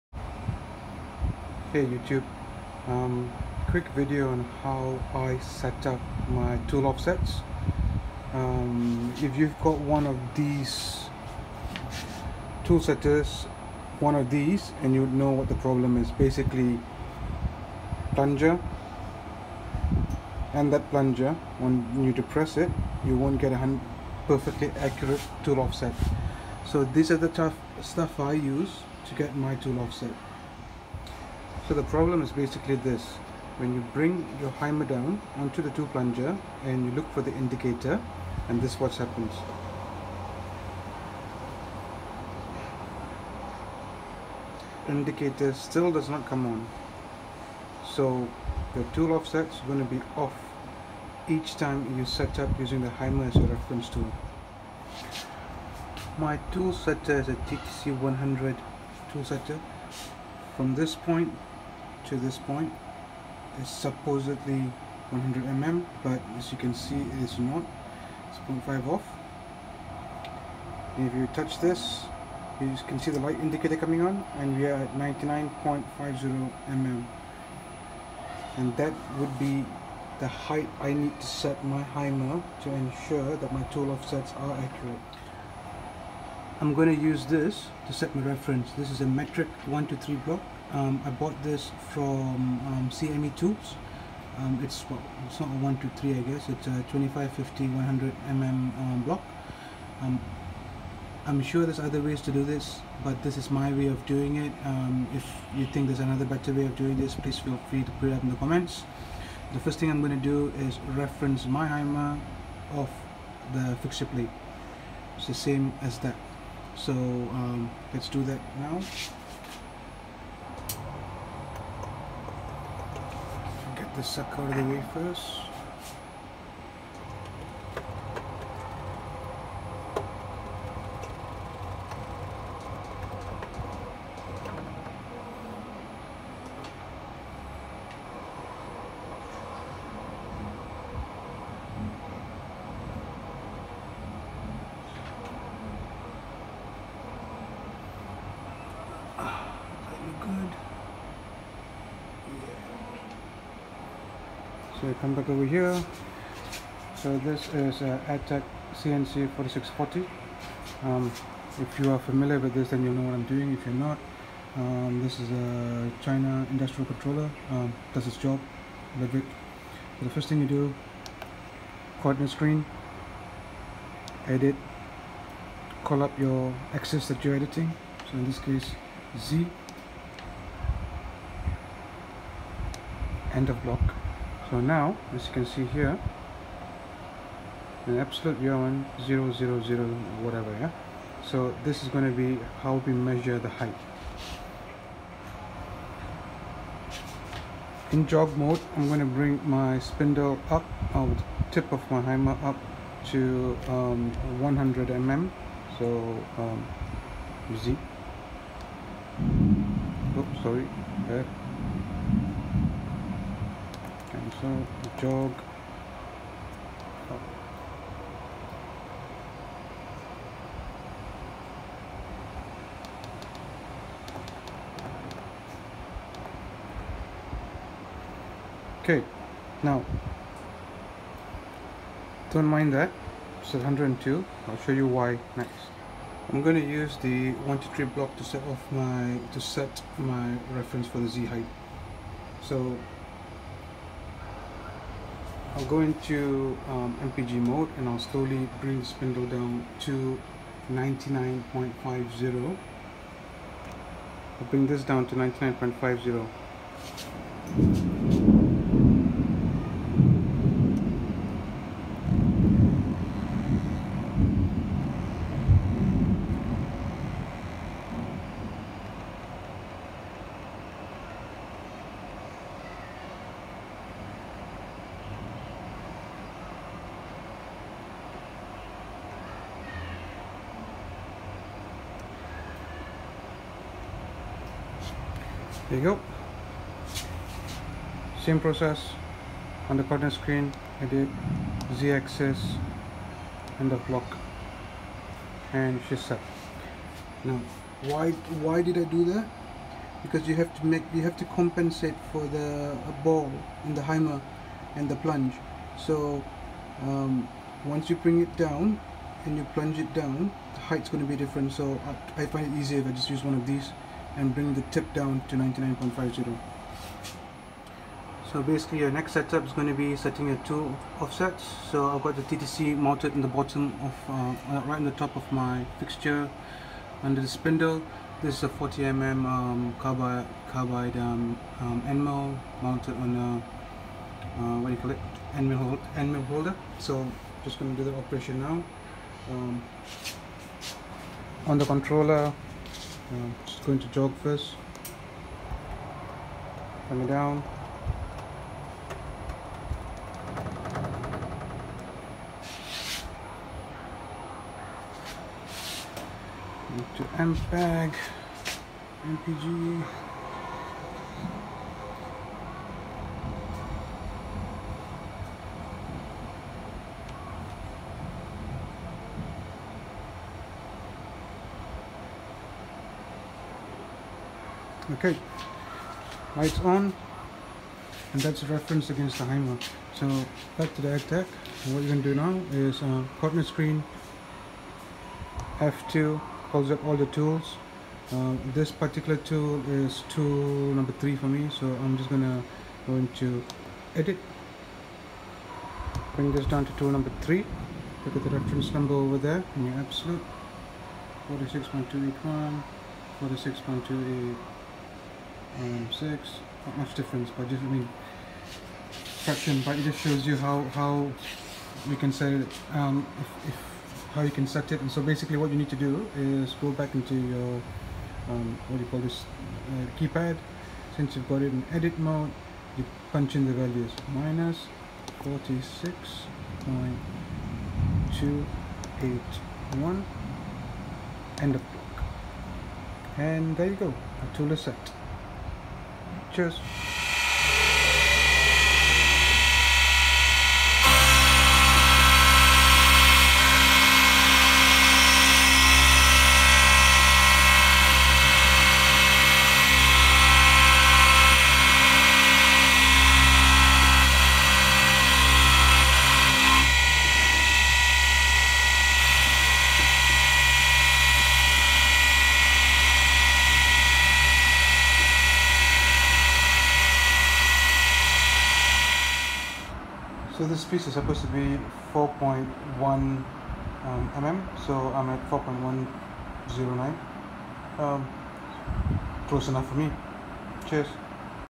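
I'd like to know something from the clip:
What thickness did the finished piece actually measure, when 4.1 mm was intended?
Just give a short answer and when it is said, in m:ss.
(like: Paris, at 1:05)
4.109 mm, at 7:55.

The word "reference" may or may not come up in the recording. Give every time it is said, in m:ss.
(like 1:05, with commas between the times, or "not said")
0:53, 1:28, 1:50, 4:00, 6:18, 6:38.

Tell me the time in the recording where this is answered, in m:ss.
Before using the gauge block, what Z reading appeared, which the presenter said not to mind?
3:53.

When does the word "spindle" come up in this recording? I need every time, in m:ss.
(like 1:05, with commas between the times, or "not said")
3:19, 4:08, 5:27.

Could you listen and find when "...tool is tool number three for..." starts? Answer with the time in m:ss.
6:29.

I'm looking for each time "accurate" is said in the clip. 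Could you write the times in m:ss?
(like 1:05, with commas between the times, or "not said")
0:24, 1:24.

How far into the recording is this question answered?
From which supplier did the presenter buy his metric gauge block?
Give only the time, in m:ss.
1:32.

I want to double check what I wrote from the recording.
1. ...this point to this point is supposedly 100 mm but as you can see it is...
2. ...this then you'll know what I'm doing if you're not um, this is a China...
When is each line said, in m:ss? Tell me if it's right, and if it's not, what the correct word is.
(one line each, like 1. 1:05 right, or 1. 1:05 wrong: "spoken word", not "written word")
1. 1:00 right
2. 2:42 right.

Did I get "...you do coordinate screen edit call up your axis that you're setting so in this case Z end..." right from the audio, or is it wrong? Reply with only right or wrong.
wrong.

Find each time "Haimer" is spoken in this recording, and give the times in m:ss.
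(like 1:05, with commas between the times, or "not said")
0:34, 0:52, 1:21, 1:51, 3:22, 5:03, 6:19.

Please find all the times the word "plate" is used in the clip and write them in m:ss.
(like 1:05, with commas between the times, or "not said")
1:54.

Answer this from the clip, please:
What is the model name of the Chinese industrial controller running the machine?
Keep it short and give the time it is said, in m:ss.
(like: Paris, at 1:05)
Adtech CNC 4640, at 2:38.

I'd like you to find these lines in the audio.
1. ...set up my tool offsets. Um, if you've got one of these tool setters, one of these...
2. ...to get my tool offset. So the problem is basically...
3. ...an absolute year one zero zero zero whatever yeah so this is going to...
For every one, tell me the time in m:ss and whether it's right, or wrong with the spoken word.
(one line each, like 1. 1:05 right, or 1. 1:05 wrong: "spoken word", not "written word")
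1. 0:05 right
2. 0:29 right
3. 3:07 right.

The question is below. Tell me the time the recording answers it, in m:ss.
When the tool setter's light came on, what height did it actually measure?
1:14.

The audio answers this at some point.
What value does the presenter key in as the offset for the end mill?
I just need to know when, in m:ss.
7:04.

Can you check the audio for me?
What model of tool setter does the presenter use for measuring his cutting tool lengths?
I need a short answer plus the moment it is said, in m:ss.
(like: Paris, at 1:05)
TTC 100, at 0:57.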